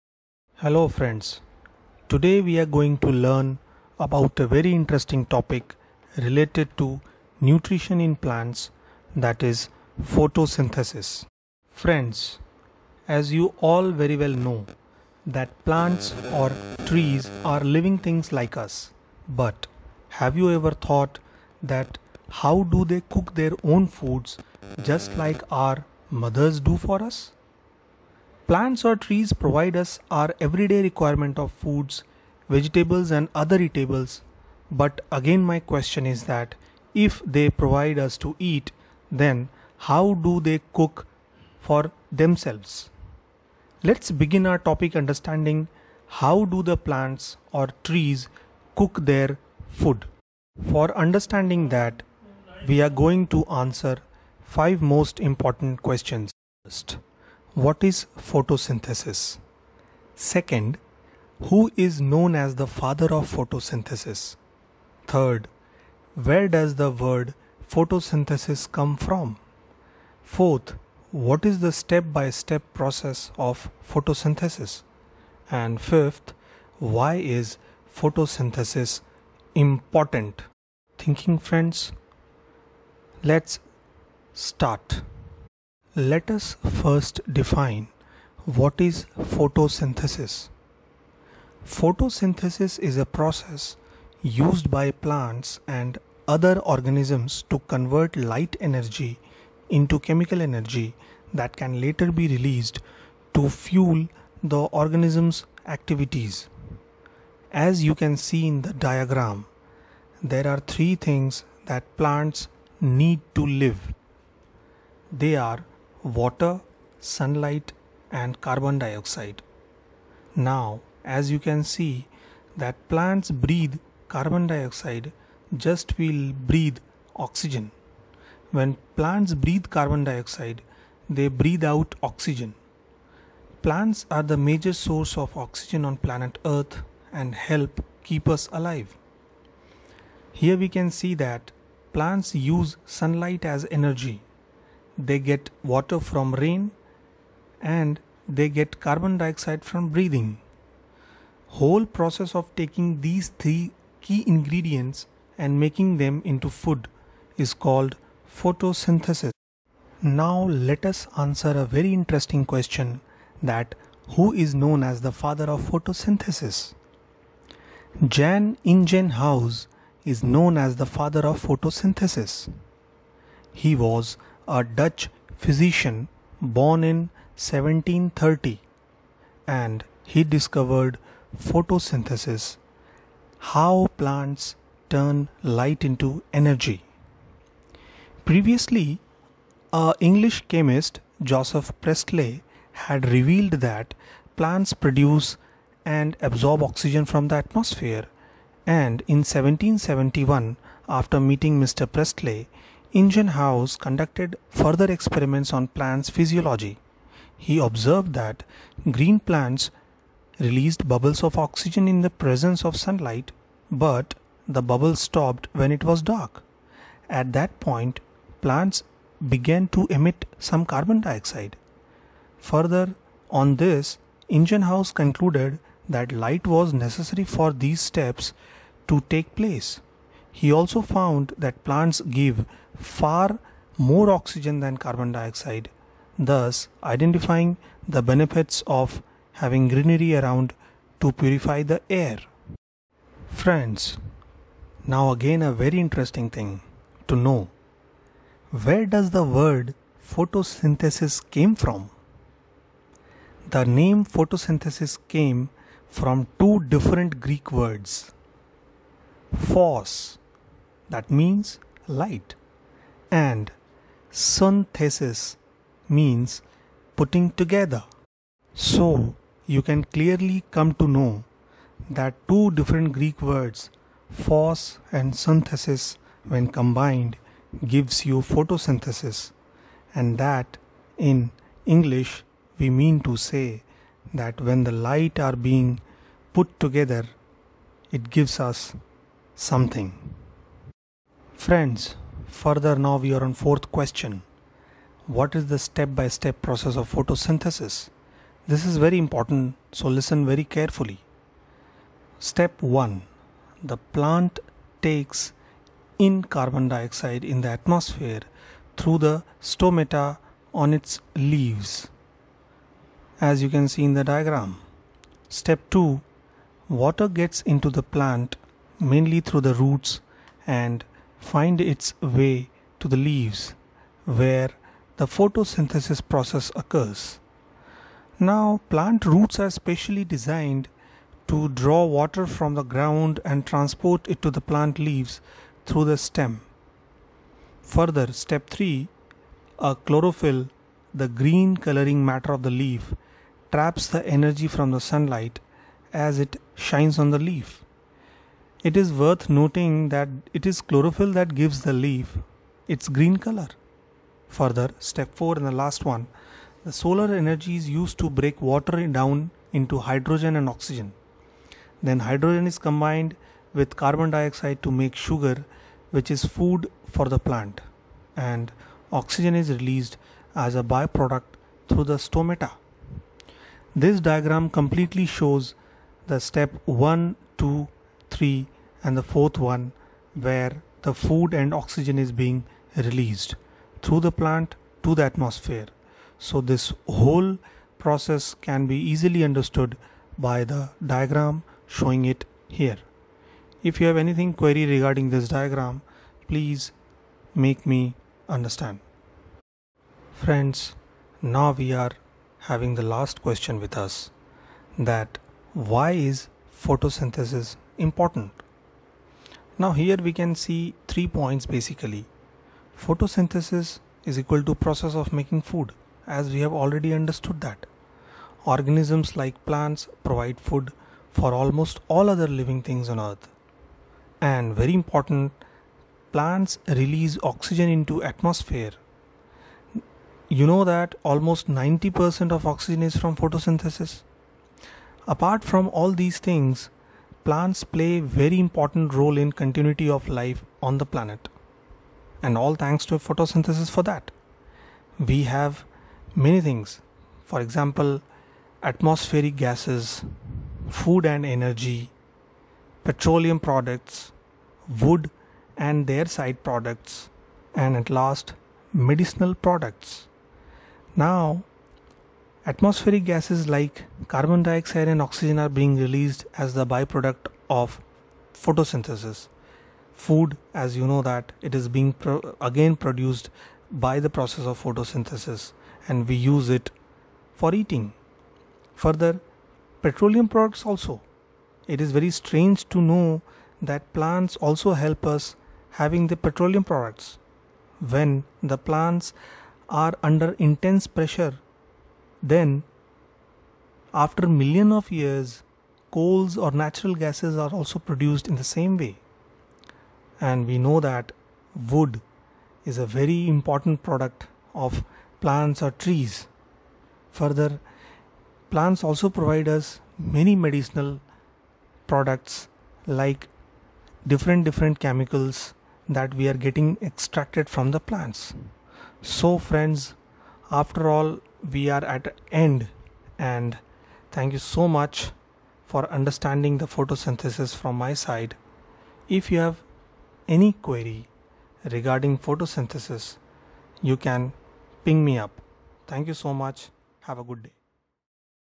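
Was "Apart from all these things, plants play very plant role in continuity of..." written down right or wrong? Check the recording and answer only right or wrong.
wrong.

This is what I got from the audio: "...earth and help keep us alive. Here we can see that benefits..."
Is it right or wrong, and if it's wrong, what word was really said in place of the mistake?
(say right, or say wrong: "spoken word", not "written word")
wrong: "plants", not "benefits".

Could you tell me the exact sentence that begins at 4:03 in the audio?
Friends, now again a very interesting thing to know.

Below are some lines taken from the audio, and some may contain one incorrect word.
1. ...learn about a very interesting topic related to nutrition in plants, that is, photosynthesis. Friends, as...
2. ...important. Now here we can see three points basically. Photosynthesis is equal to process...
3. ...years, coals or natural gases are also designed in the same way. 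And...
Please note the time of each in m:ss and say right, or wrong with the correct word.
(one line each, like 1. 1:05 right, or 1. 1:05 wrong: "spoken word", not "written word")
1. 0:03 right
2. 6:47 right
3. 8:14 wrong: "produced", not "designed".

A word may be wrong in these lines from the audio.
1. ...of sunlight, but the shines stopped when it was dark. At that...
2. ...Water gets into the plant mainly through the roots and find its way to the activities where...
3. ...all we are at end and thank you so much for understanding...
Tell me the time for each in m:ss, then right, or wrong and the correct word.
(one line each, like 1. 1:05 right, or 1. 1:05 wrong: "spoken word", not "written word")
1. 3:32 wrong: "bubbles", not "shines"
2. 5:16 wrong: "leaves", not "activities"
3. 8:40 right.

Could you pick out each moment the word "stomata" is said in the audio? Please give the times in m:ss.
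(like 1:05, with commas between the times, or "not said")
5:09, 6:11.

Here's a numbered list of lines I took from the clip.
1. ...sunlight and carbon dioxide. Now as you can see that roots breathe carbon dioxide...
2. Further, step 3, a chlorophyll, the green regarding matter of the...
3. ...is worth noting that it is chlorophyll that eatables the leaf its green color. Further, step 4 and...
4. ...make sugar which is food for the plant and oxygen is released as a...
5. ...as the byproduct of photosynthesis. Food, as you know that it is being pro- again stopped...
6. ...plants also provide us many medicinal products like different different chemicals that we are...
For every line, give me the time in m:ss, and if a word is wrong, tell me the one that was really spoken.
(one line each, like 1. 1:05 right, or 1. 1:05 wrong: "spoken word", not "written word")
1. 1:56 wrong: "plants", not "roots"
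2. 5:37 wrong: "coloring", not "regarding"
3. 5:48 wrong: "gives", not "eatables"
4. 6:04 right
5. 7:46 wrong: "produced", not "stopped"
6. 8:28 right.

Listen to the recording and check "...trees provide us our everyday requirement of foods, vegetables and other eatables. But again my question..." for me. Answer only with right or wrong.
right.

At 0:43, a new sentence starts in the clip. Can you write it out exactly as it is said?
Let's begin our topic understanding how do the plants or trees cook their food.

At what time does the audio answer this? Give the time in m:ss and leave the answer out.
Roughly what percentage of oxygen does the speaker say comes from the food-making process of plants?
7:11.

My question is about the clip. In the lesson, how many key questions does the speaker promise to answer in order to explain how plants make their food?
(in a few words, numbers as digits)
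5.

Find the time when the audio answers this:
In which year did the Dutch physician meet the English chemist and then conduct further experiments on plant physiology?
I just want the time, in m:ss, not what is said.
3:19.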